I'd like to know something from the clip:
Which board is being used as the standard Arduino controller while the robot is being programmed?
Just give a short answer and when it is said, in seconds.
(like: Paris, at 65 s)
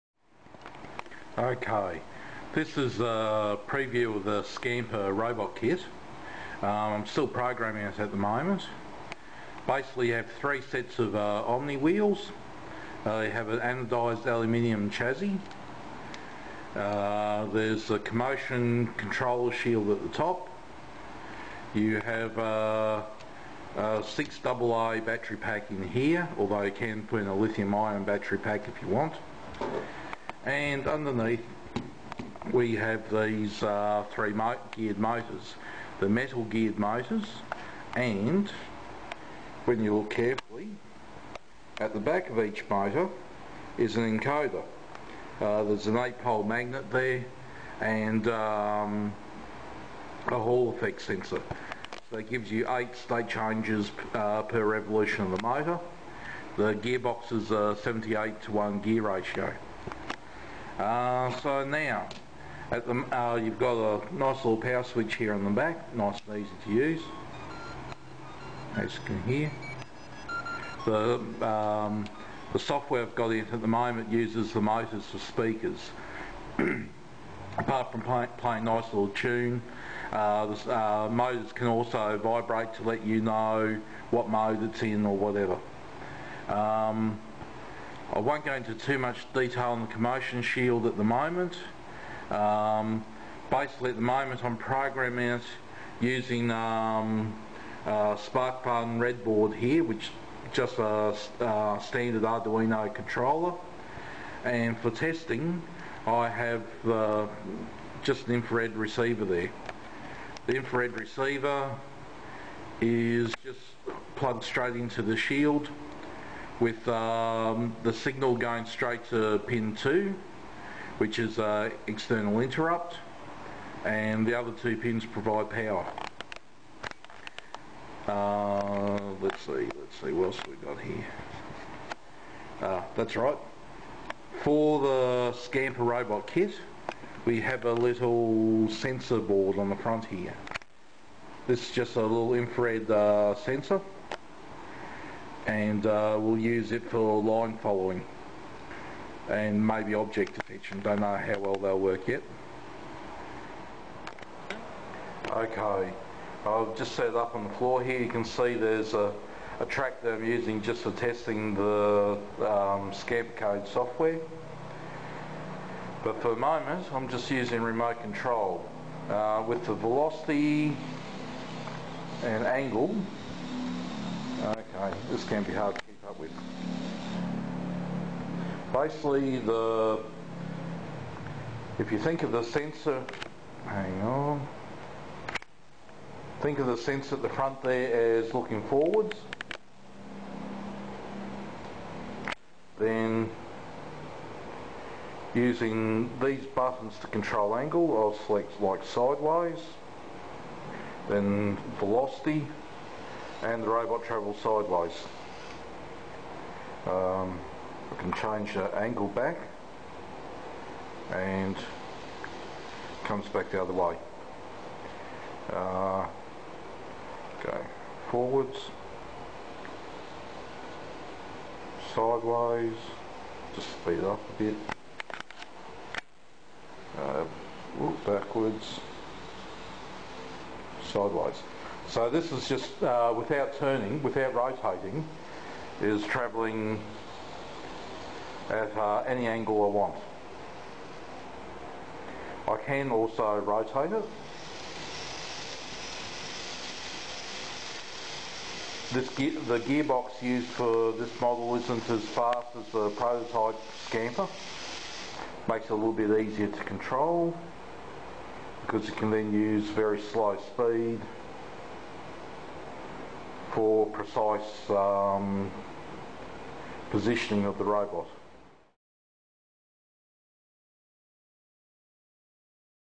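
SparkFun Redboard, at 98 s.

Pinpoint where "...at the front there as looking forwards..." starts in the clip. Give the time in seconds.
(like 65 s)
187 s.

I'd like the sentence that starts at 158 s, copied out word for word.
You can see there's a, a track that I'm using just for testing the um, SCAB code software.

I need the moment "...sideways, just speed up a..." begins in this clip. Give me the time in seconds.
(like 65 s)
221 s.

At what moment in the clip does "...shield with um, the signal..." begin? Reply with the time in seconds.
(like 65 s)
115 s.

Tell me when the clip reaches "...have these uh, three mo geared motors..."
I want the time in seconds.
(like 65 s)
32 s.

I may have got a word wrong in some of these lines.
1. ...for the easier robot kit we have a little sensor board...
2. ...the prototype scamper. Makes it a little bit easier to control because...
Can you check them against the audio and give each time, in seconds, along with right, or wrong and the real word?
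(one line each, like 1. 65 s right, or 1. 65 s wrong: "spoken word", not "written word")
1. 134 s wrong: "scamper", not "easier"
2. 252 s right.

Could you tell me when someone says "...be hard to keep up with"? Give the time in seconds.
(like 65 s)
175 s.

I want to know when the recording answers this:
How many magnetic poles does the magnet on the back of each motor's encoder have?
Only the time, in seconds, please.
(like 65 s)
45 s.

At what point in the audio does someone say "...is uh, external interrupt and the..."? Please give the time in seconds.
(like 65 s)
121 s.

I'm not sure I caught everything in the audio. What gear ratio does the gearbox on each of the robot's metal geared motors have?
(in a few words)
78 to 1.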